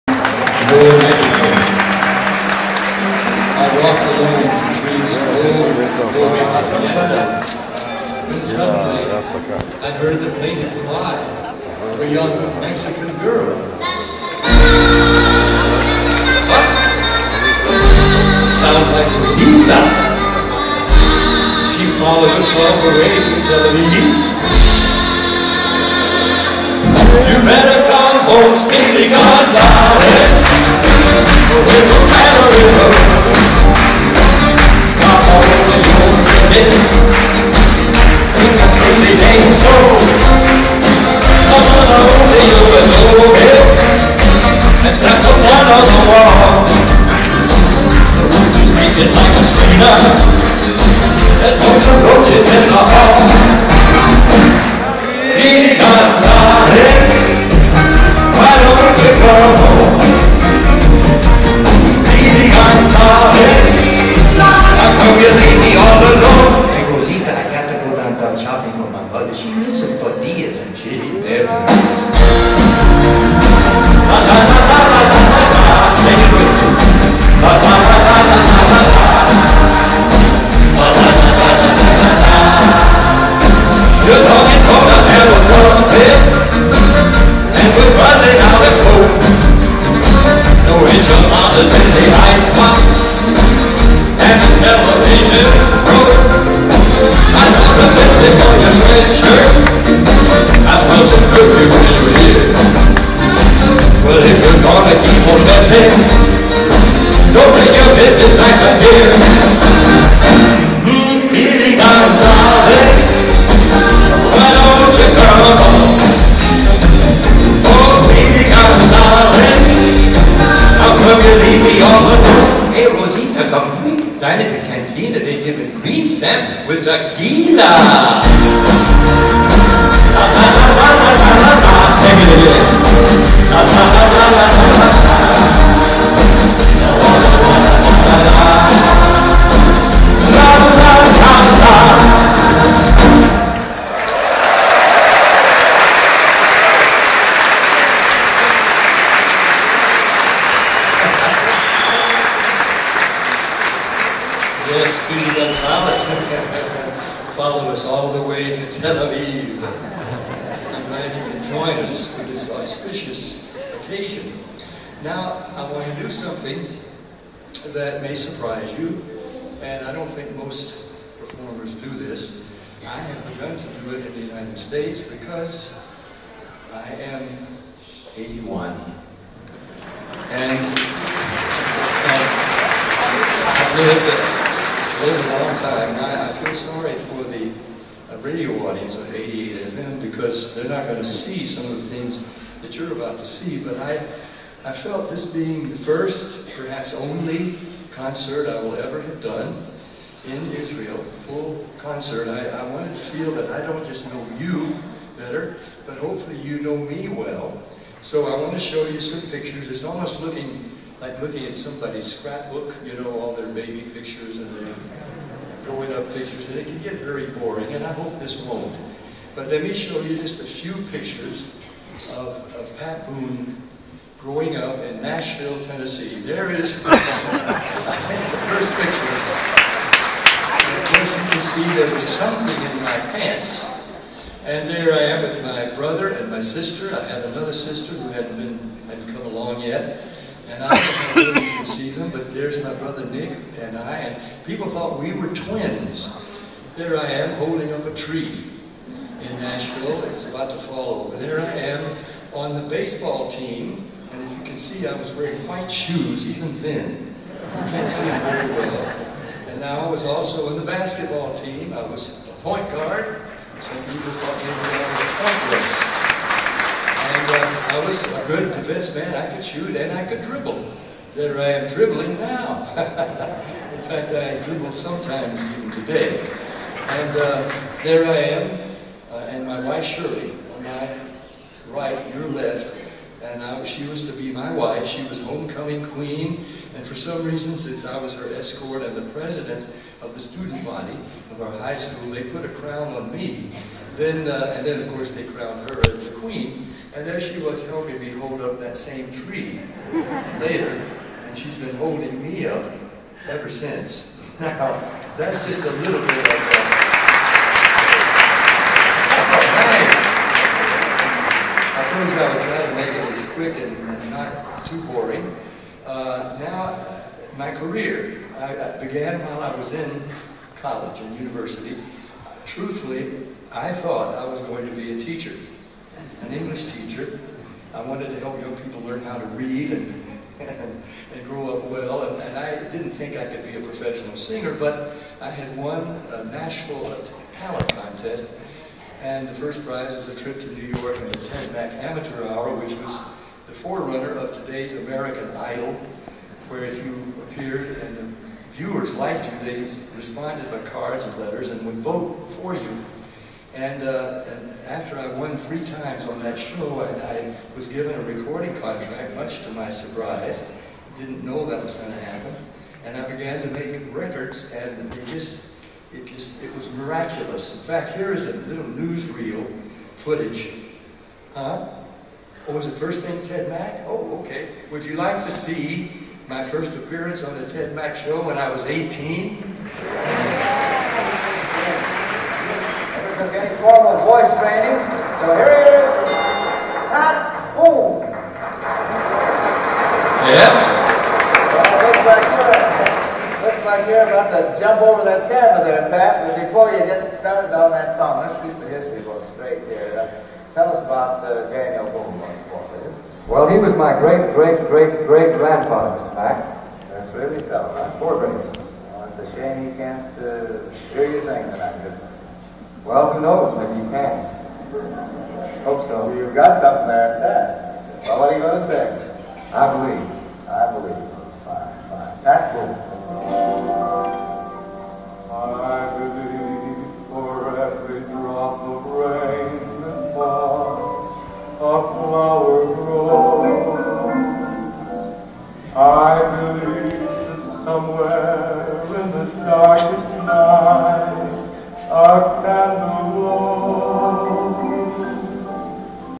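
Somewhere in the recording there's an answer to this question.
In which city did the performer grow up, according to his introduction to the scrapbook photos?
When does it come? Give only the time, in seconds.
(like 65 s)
225 s.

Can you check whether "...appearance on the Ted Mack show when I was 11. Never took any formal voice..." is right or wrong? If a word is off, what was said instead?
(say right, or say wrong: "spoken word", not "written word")
wrong: "18", not "11".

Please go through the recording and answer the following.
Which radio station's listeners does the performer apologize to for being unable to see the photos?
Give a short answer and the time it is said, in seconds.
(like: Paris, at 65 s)
88 FM, at 189 s.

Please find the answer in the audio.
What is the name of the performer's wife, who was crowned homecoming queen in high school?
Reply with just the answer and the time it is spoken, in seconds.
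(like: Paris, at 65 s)
Shirley, at 279 s.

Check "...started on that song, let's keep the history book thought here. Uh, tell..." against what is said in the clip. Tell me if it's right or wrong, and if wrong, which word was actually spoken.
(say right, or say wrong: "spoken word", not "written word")
wrong: "straight", not "thought".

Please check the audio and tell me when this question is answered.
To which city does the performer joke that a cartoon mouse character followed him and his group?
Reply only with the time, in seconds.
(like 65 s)
158 s.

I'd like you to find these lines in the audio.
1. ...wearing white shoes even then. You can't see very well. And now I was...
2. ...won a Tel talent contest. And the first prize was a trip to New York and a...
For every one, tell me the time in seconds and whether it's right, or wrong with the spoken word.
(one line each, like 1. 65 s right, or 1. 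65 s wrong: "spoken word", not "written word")
1. 255 s right
2. 335 s wrong: "Nashville", not "Tel".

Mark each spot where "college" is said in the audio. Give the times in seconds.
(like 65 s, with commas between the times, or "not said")
320 s.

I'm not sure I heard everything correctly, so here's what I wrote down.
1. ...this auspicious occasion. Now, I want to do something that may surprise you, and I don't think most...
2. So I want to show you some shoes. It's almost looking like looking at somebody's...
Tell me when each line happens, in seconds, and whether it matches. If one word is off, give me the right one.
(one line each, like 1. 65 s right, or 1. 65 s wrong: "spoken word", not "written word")
1. 162 s right
2. 208 s wrong: "pictures", not "shoes".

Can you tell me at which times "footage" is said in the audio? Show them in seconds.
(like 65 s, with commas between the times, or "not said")
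369 s.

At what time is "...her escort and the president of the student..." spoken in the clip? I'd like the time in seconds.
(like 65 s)
288 s.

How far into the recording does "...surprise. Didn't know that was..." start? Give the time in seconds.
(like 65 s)
359 s.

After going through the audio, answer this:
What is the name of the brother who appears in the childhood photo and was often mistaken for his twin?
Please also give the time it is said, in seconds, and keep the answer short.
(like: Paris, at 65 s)
Nick, at 243 s.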